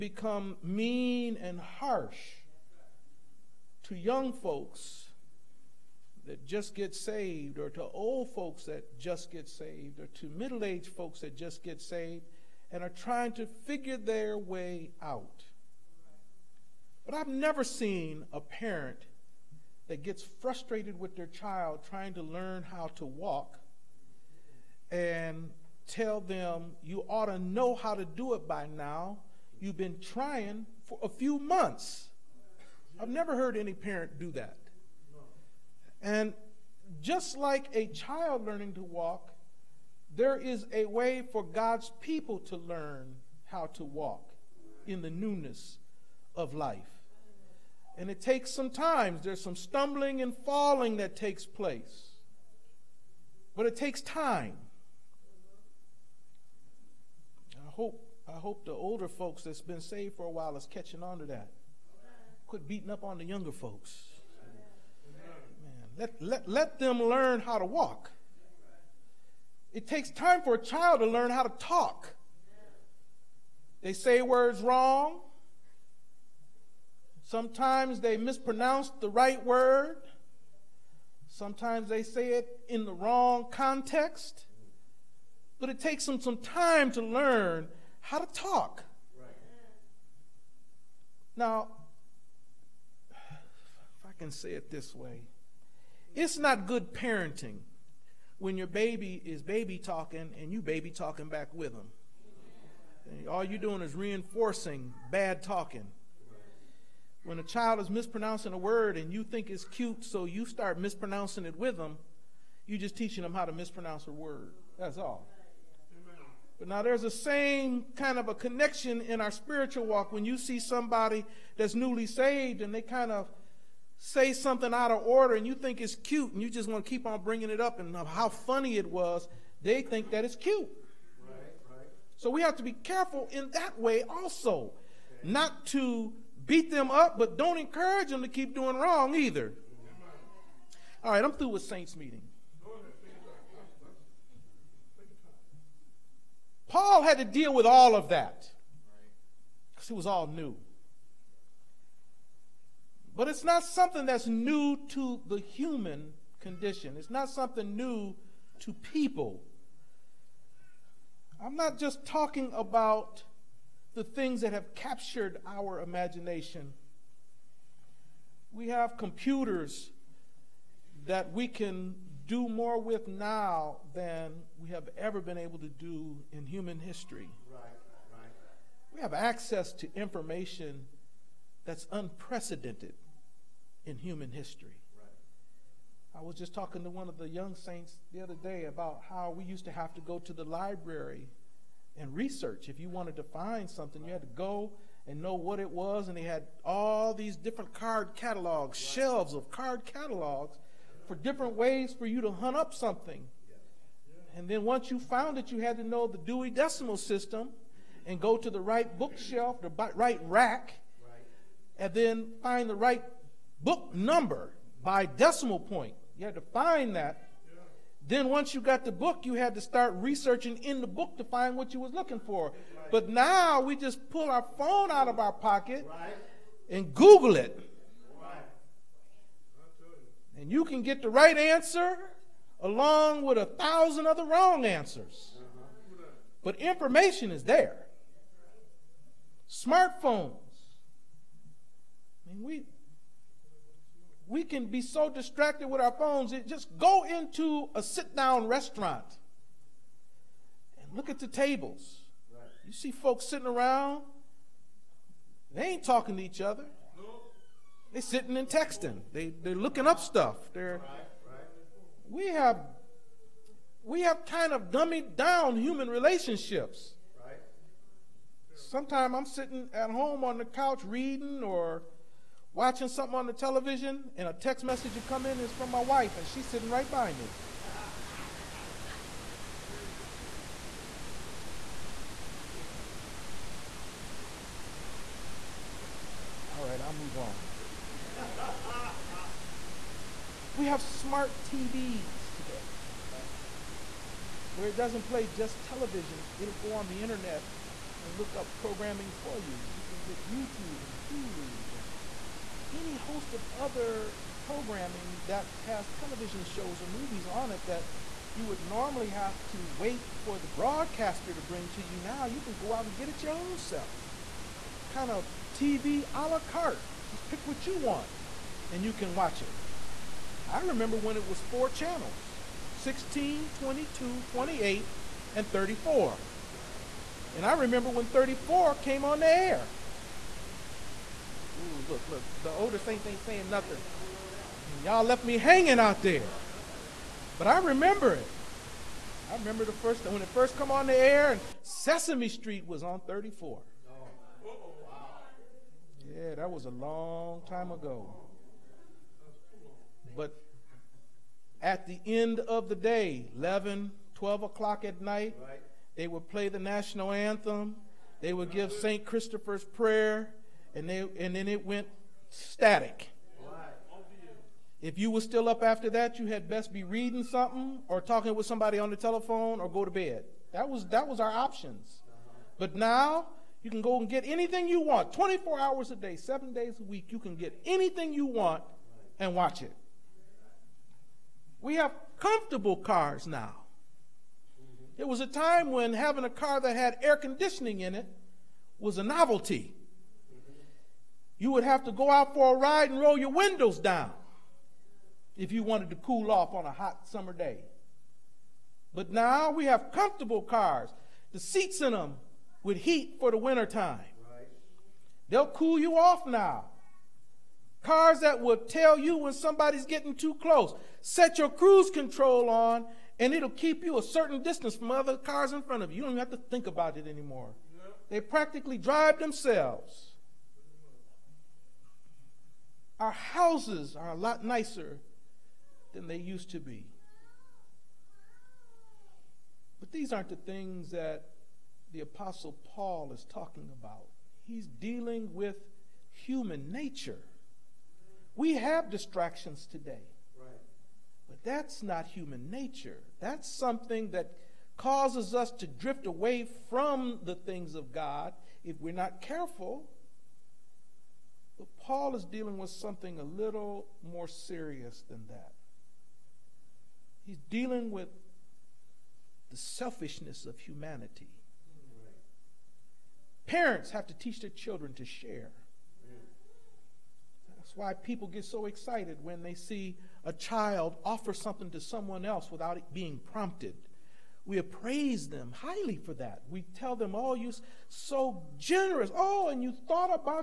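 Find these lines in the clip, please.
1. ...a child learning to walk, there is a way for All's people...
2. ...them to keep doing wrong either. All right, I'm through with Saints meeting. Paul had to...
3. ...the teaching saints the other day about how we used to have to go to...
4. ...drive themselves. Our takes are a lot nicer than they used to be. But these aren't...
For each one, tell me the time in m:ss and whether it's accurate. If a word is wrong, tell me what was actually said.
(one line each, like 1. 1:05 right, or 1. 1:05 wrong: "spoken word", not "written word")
1. 0:37 wrong: "God", not "All"
2. 2:18 right
3. 3:07 wrong: "young", not "teaching"
4. 6:58 wrong: "houses", not "takes".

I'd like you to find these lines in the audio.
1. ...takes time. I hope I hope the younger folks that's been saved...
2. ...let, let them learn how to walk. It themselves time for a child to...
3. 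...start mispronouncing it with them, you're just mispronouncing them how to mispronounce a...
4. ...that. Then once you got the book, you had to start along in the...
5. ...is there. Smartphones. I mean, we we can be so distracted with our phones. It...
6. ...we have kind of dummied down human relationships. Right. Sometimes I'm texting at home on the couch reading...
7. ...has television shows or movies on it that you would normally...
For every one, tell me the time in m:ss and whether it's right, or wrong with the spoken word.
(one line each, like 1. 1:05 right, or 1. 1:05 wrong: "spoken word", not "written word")
1. 0:53 wrong: "older", not "younger"
2. 1:06 wrong: "takes", not "themselves"
3. 1:50 wrong: "teaching", not "mispronouncing"
4. 3:36 wrong: "researching", not "along"
5. 3:57 right
6. 4:23 wrong: "sitting", not "texting"
7. 5:05 right.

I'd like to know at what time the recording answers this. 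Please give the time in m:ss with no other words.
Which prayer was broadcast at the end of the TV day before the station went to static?
5:58.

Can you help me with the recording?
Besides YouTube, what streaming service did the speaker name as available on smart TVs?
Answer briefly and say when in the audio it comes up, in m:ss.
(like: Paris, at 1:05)
Hulu, at 5:01.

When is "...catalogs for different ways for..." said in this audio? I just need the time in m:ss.
3:19.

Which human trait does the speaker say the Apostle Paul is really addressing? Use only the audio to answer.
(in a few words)
Selfishness.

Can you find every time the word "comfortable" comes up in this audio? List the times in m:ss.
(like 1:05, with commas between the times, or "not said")
6:22, 6:39.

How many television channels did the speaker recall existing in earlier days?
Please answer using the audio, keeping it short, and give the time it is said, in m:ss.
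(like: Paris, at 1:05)
4, at 5:21.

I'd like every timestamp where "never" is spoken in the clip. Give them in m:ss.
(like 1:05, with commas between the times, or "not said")
0:17, 0:33.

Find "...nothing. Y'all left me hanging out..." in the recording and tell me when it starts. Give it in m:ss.
5:33.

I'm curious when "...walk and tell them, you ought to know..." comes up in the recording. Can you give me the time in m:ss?
0:23.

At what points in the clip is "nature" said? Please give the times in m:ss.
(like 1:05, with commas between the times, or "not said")
7:16, 7:22.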